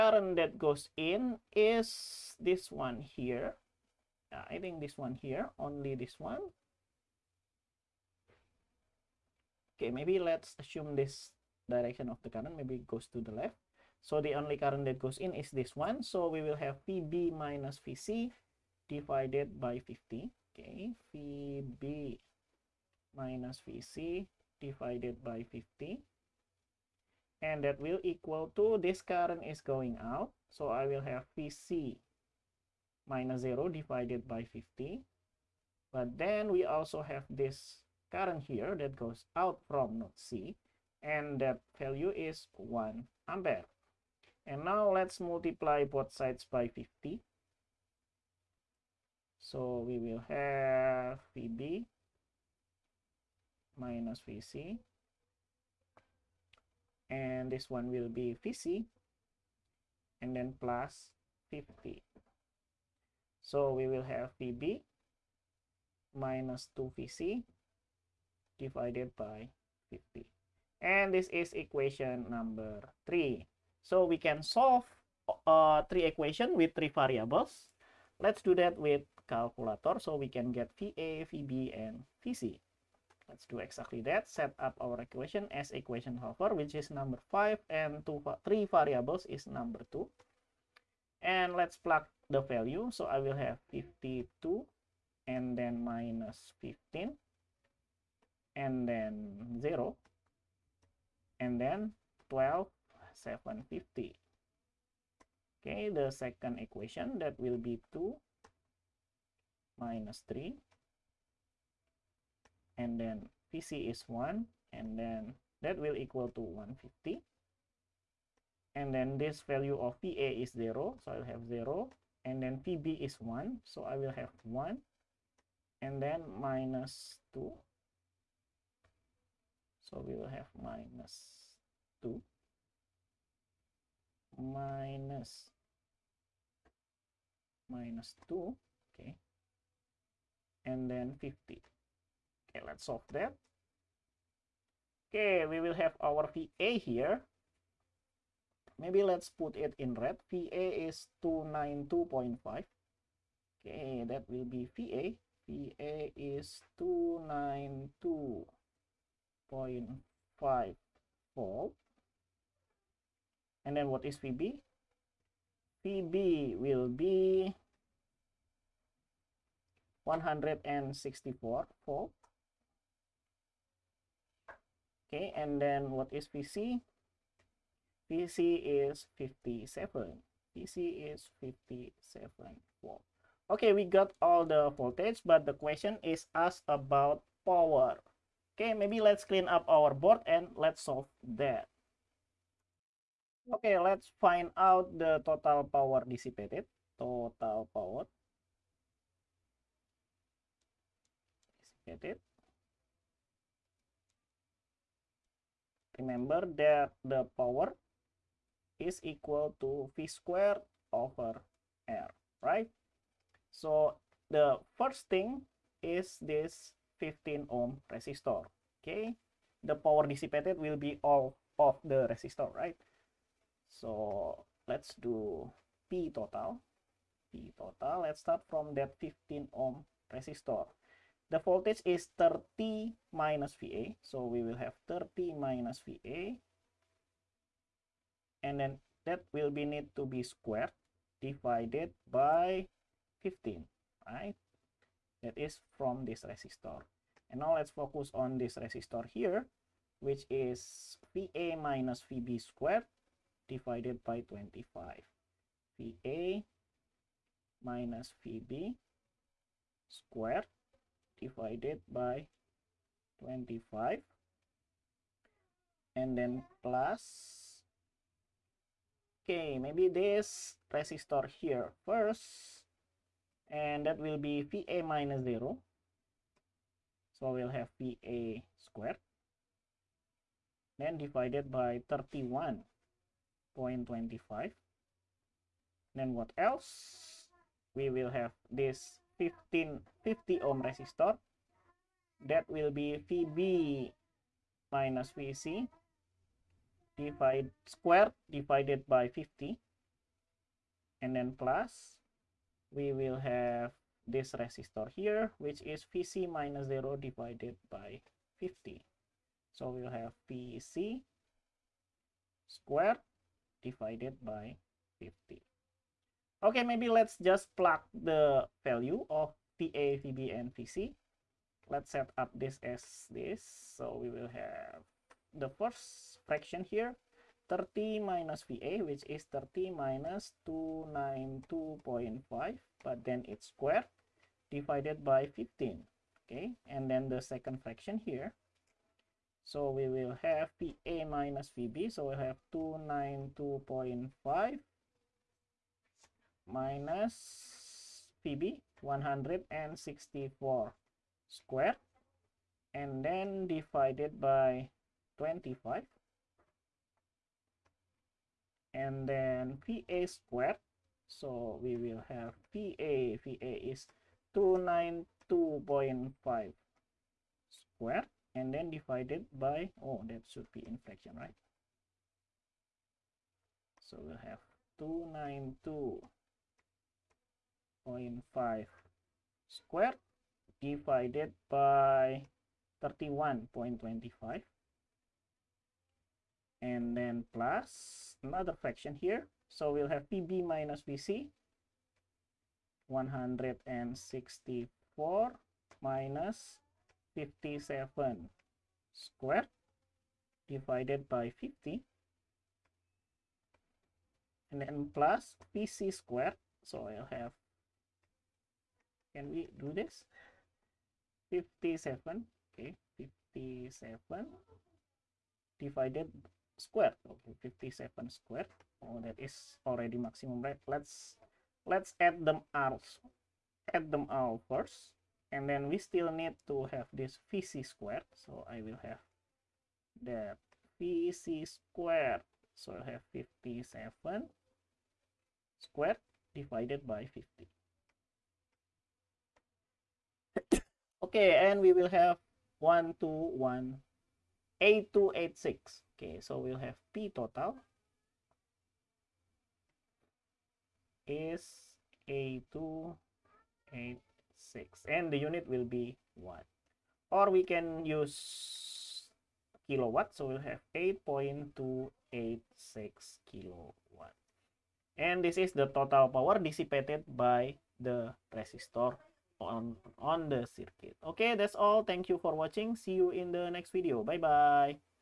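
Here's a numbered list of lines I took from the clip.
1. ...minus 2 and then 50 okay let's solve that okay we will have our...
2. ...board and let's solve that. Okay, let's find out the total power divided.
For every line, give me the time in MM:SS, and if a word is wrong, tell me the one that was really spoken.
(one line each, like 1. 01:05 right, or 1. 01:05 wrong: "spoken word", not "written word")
1. 02:17 right
2. 03:09 wrong: "dissipated", not "divided".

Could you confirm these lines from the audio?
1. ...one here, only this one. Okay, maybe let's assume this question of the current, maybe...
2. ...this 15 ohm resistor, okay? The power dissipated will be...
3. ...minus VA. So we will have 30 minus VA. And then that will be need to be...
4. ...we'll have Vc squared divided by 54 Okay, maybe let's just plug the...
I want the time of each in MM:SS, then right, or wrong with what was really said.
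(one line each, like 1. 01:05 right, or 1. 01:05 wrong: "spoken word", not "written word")
1. 00:04 wrong: "direction", not "question"
2. 03:36 right
3. 03:53 right
4. 05:09 wrong: "50", not "54".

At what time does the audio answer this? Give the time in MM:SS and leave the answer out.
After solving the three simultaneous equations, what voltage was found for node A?
02:36.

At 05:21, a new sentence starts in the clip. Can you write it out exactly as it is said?
Let's set up this as this.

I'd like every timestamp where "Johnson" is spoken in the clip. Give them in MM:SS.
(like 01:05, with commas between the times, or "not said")
not said.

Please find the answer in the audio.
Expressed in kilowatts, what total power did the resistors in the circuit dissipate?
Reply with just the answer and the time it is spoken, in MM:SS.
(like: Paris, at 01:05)
8.286 kilowatts, at 07:40.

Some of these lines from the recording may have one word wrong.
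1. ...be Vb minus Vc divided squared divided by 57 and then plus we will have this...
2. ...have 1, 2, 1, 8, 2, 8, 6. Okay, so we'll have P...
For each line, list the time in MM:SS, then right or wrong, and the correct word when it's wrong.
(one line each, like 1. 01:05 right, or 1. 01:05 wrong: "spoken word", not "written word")
1. 04:52 wrong: "50", not "57"
2. 07:21 right.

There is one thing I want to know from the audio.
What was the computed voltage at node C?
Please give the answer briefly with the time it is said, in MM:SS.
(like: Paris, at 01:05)
57 volts, at 03:01.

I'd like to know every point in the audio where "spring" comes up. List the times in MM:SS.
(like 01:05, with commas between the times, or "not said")
not said.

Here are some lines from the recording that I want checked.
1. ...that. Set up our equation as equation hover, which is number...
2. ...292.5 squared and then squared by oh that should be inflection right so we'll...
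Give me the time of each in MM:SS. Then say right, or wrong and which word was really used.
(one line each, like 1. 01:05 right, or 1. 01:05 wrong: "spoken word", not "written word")
1. 01:24 right
2. 06:04 wrong: "divided", not "squared".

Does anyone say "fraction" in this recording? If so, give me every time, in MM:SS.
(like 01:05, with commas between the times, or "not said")
05:26, 05:37, 06:28.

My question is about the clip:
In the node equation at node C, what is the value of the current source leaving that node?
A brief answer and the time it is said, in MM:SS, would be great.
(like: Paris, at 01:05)
1 ampere, at 00:42.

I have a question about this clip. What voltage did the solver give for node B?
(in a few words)
164 volts.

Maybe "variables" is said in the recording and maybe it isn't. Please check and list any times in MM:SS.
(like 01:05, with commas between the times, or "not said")
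01:16, 01:28.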